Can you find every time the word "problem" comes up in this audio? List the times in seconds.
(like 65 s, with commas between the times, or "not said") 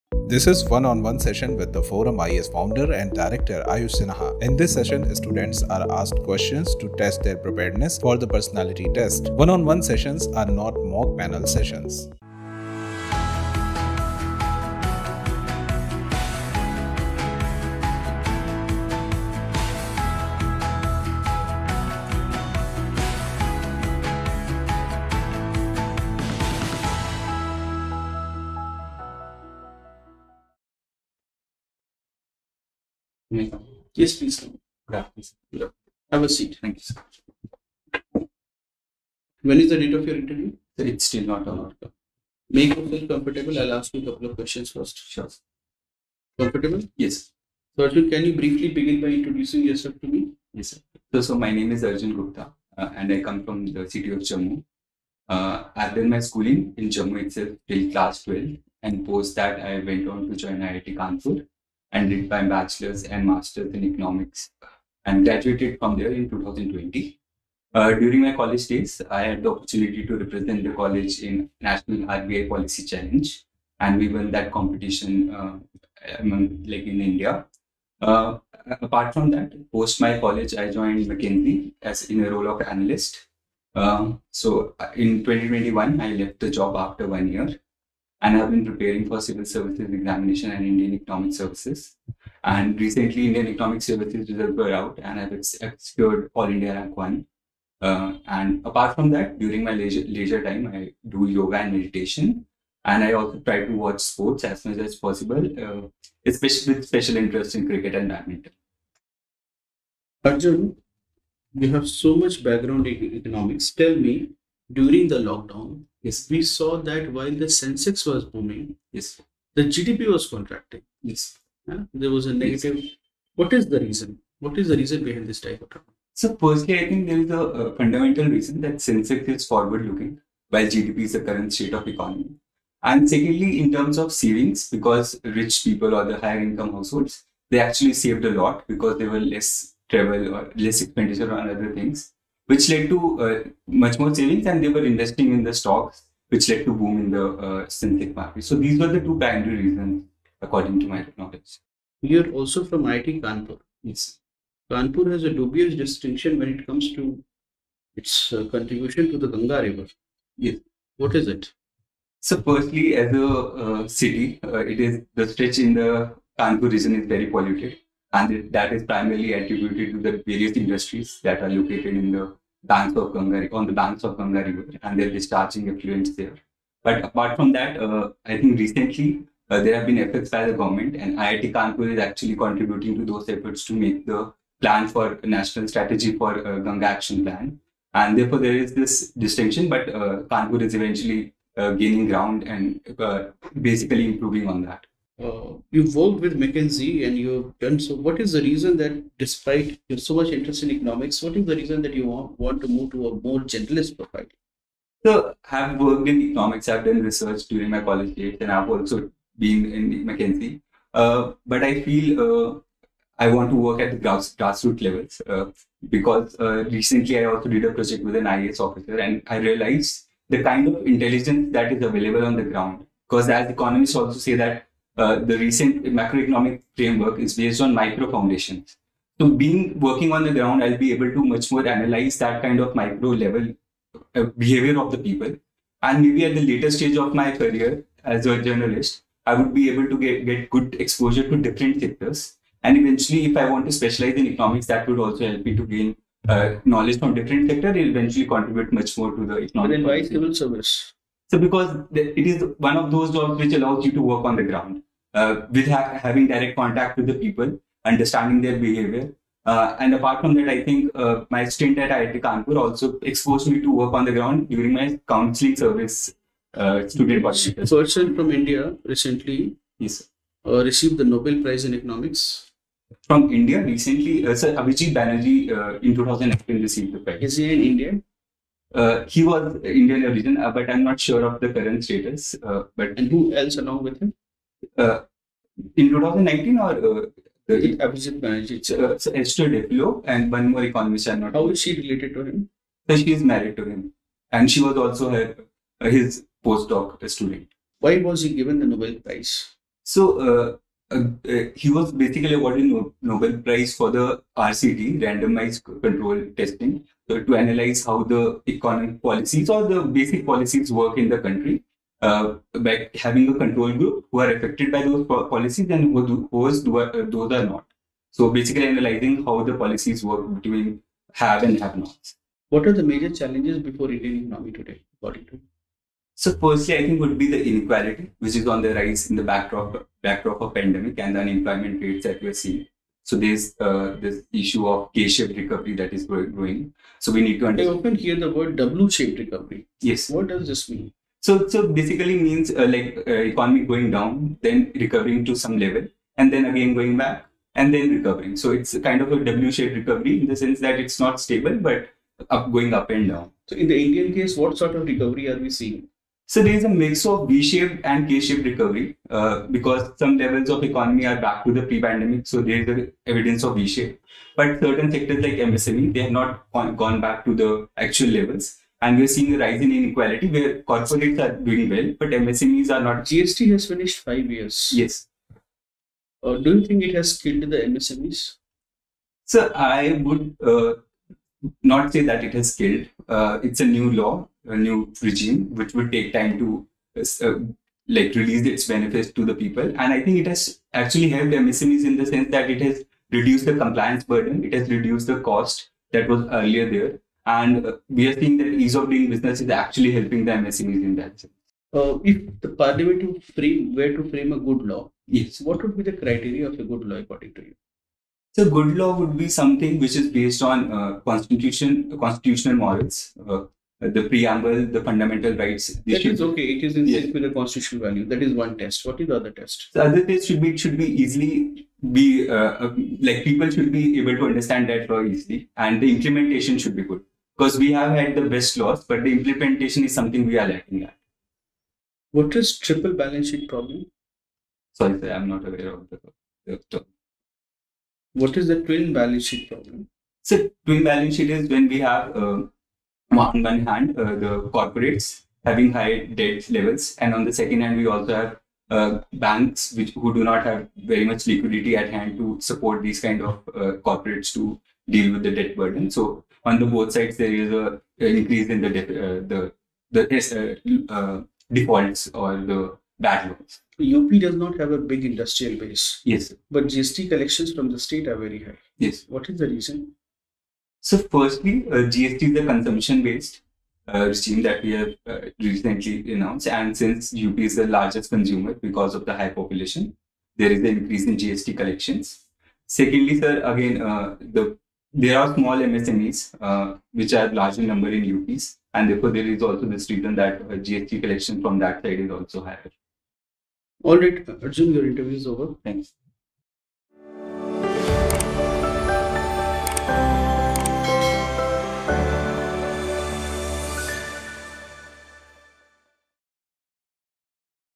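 433 s, 439 s.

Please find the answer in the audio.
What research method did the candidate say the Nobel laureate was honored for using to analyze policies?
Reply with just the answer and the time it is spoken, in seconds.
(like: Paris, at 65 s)
randomized control testing, at 305 s.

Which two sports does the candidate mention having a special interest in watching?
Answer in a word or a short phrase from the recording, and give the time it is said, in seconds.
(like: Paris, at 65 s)
cricket and badminton, at 107 s.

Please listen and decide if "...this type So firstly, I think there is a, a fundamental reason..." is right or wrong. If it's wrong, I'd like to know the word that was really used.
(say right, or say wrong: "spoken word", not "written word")
right.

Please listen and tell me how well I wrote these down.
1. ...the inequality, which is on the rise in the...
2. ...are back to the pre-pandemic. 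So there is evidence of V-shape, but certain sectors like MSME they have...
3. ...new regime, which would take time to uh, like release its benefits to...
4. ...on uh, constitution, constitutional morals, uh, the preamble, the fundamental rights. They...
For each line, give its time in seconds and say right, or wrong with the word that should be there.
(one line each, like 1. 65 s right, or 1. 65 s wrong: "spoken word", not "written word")
1. 327 s right
2. 361 s right
3. 384 s right
4. 410 s right.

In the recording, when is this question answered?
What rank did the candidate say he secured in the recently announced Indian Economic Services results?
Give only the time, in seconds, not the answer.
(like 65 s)
96 s.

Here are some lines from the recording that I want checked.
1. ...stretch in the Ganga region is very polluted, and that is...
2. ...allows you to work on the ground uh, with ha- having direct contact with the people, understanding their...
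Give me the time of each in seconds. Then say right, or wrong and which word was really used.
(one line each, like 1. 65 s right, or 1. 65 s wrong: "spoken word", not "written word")
1. 165 s wrong: "Kanpur", not "Ganga"
2. 253 s right.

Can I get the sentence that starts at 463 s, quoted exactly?
UP does not have a big industrial base.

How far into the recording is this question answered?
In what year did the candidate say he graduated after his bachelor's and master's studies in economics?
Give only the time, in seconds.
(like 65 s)
66 s.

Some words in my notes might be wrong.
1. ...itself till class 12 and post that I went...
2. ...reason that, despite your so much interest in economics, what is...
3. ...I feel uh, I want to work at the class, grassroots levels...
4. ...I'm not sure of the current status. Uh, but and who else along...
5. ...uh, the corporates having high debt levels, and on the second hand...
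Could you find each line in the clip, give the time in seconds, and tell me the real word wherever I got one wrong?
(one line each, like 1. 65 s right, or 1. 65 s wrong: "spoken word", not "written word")
1. 57 s right
2. 198 s right
3. 211 s wrong: "grass", not "class"
4. 280 s right
5. 443 s right.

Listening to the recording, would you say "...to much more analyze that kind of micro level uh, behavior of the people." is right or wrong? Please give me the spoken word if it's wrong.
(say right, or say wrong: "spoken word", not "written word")
right.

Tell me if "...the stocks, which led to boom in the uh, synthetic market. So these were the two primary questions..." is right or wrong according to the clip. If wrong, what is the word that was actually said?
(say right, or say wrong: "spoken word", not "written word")
wrong: "reasons", not "questions".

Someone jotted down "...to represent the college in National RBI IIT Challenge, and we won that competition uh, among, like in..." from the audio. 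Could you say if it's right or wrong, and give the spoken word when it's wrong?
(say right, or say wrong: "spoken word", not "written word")
wrong: "Policy", not "IIT".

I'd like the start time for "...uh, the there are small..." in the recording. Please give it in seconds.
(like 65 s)
483 s.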